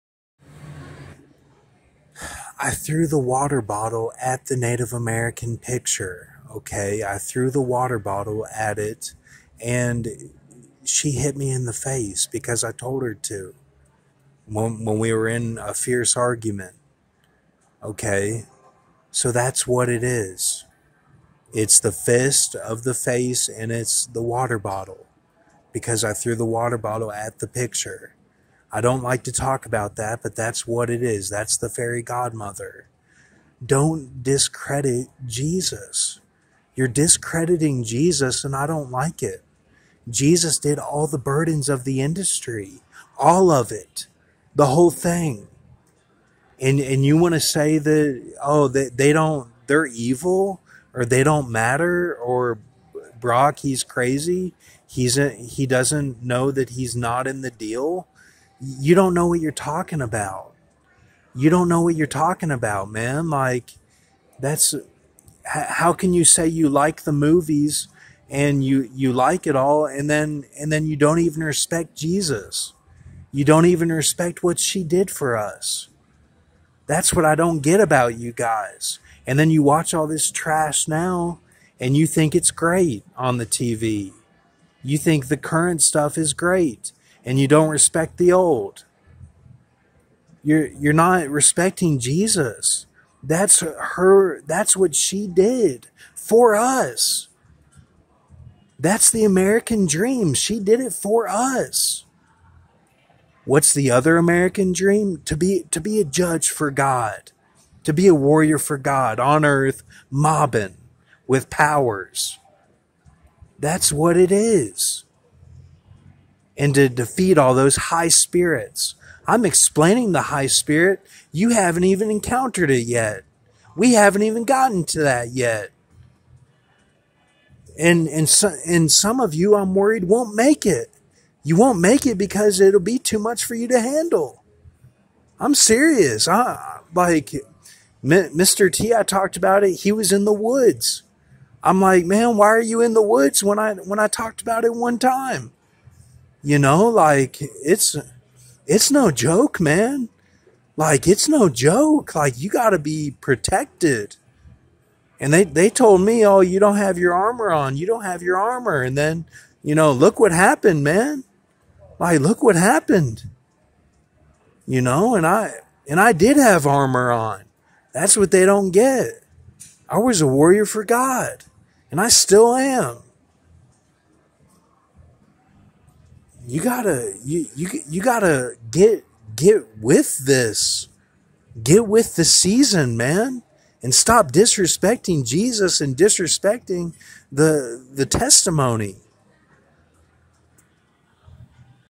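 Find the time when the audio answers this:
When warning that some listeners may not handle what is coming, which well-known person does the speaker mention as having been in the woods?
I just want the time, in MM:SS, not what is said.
02:18.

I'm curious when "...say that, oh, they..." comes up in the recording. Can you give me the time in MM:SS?
00:47.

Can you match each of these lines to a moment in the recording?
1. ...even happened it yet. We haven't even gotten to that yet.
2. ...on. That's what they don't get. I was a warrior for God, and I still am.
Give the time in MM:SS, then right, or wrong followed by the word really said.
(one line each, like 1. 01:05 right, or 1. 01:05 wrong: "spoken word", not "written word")
1. 02:01 wrong: "encountered", not "happened"
2. 02:47 right.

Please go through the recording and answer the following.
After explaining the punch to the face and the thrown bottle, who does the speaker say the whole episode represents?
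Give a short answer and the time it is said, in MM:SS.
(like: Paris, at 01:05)
The fairy godmother, at 00:31.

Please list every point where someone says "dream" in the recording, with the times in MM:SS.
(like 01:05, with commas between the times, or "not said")
01:39, 01:44.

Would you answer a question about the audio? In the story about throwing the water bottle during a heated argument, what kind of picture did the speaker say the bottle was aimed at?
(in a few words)
Native American picture.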